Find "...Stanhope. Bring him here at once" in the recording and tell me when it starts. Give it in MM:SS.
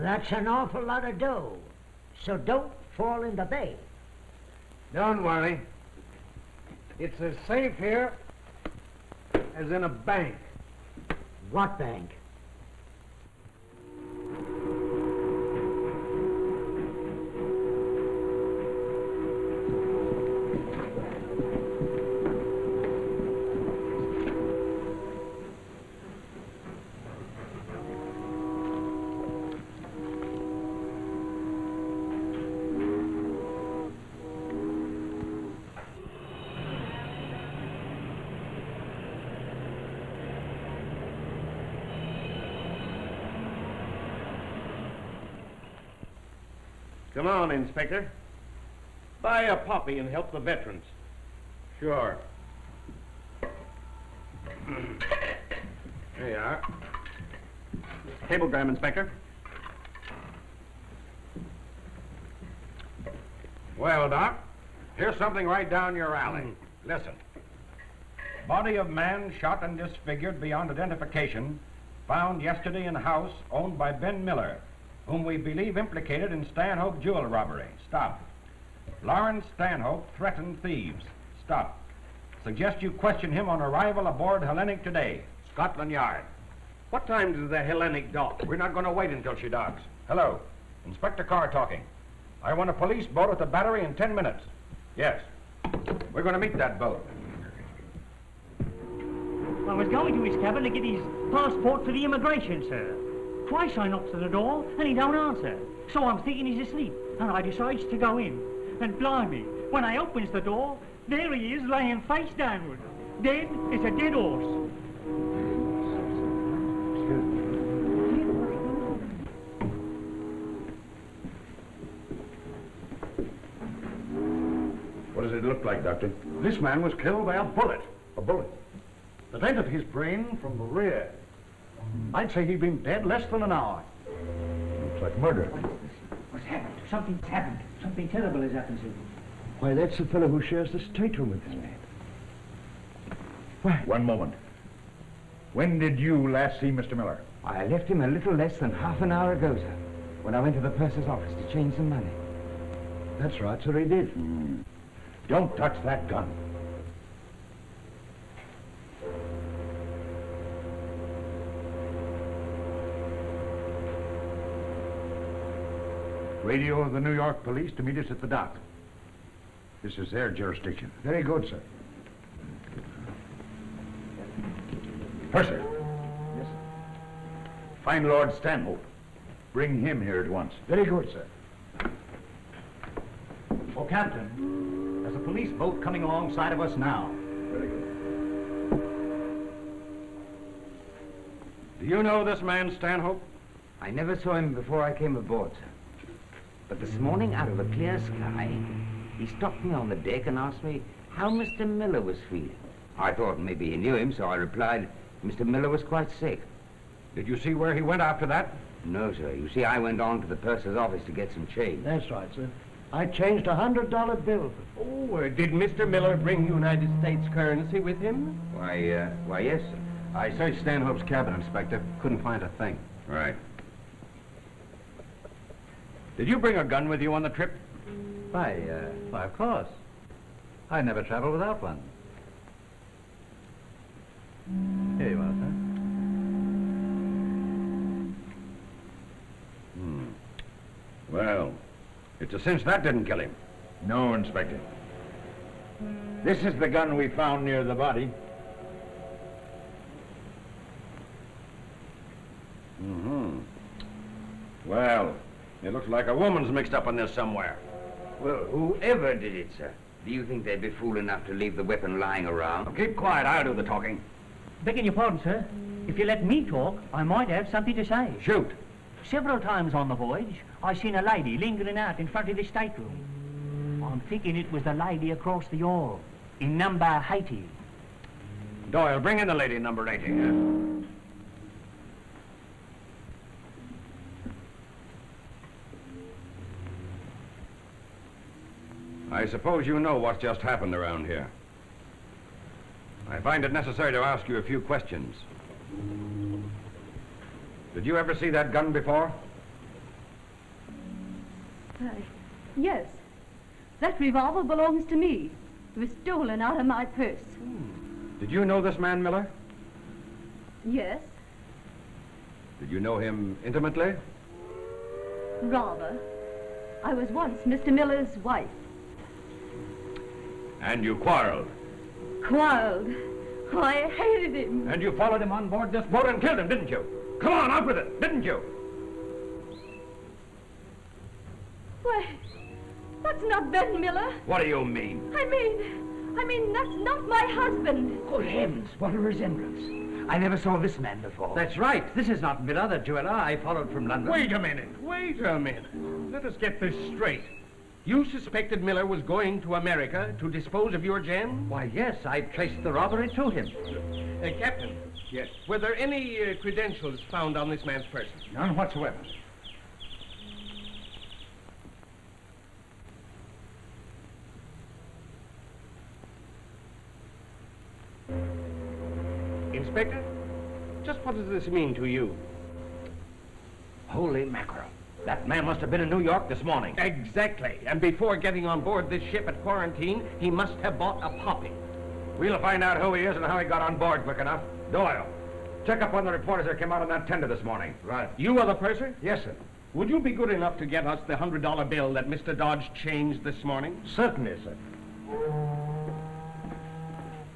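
02:58.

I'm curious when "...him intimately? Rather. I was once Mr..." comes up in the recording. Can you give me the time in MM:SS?
05:12.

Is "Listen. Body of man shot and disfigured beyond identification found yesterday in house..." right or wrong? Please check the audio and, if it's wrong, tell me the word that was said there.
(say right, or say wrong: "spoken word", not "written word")
right.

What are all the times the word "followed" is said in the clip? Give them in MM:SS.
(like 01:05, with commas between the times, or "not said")
05:24, 05:43.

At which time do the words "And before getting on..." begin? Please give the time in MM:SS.
06:17.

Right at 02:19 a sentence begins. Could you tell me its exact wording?
Why, that's the fellow who shares the stateroom with this man.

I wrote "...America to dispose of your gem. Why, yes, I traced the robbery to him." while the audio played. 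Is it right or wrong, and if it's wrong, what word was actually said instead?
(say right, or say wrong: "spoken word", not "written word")
right.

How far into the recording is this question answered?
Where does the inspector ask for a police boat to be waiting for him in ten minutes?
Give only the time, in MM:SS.
01:33.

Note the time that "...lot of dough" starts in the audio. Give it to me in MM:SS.
00:00.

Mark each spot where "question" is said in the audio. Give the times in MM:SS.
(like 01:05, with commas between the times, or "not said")
01:22, 04:54.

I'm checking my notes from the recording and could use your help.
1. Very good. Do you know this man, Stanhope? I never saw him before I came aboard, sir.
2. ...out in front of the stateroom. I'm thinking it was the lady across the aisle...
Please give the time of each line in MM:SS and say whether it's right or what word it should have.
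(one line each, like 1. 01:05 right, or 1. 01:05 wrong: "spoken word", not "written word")
1. 03:07 right
2. 04:31 right.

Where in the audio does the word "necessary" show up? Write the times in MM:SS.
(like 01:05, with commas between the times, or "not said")
04:53.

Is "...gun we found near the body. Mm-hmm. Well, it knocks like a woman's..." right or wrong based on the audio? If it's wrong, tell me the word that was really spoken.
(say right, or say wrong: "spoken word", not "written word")
wrong: "looks", not "knocks".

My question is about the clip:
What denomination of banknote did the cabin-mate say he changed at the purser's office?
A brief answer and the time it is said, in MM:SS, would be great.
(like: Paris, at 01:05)
$100, at 03:33.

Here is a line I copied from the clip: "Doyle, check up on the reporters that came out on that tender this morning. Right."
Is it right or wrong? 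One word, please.
right.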